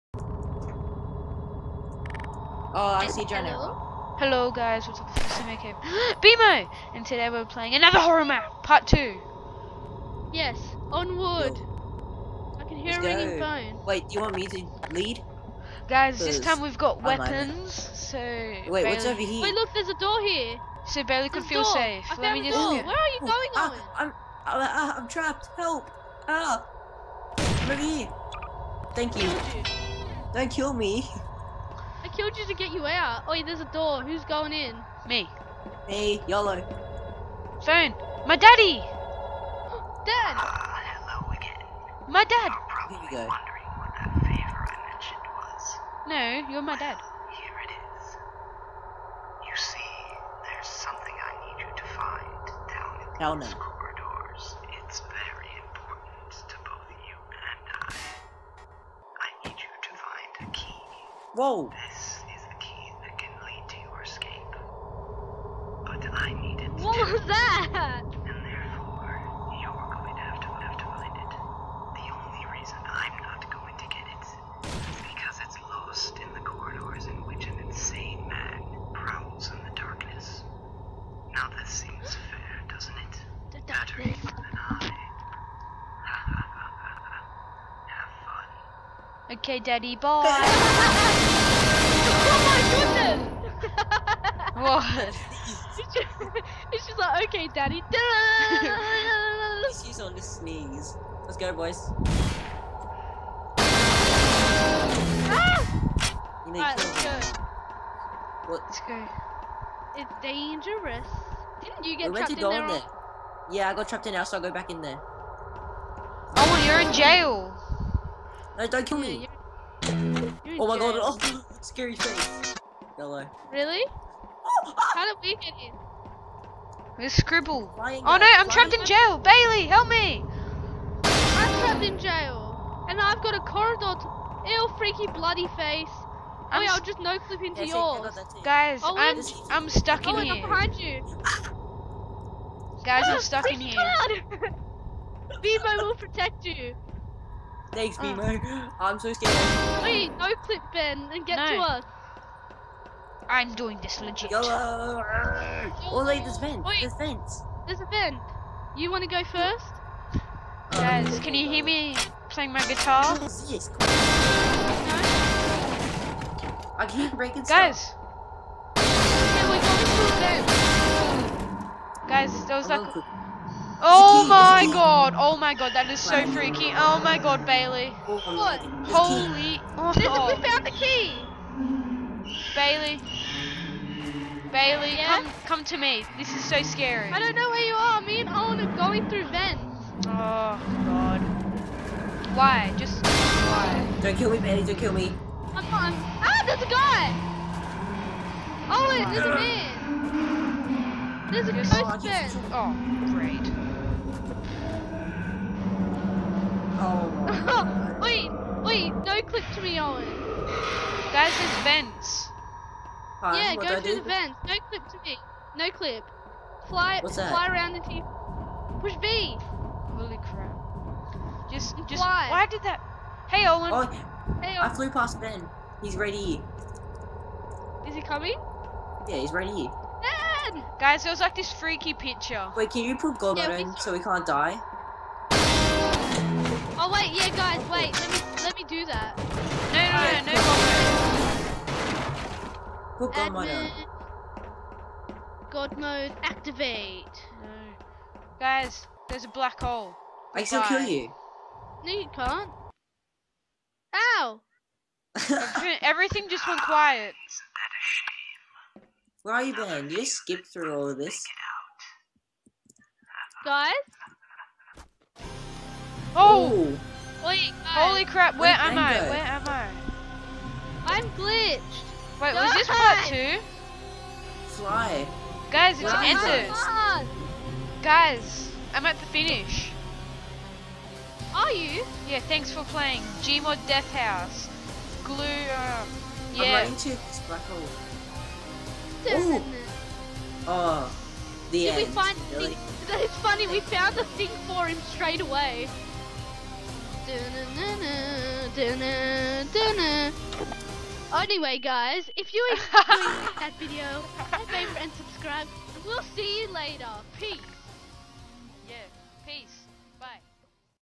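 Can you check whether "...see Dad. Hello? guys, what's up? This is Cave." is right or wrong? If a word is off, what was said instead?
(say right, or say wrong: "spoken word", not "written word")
wrong: "Jenna", not "Dad".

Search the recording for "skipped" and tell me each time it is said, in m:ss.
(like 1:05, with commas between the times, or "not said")
4:20.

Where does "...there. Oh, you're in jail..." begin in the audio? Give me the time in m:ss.
1:54.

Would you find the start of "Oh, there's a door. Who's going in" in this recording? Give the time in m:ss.
0:33.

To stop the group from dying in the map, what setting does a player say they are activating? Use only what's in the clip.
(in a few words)
God mode.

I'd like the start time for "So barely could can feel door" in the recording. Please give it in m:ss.
0:20.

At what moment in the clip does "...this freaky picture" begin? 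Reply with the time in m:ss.
3:51.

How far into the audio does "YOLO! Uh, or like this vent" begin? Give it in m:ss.
2:34.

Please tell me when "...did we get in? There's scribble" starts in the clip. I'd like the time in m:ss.
2:05.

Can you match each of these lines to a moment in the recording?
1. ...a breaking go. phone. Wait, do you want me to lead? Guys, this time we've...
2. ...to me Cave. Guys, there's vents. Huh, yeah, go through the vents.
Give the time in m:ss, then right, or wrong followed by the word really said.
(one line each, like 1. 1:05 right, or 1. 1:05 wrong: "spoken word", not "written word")
1. 0:13 wrong: "ringing", not "breaking"
2. 3:29 wrong: "Owen", not "Cave".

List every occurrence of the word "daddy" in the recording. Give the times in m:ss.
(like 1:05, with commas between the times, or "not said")
0:38, 1:29, 1:37.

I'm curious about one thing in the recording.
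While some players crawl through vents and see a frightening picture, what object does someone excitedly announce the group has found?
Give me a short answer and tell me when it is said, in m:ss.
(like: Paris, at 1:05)
the key, at 3:00.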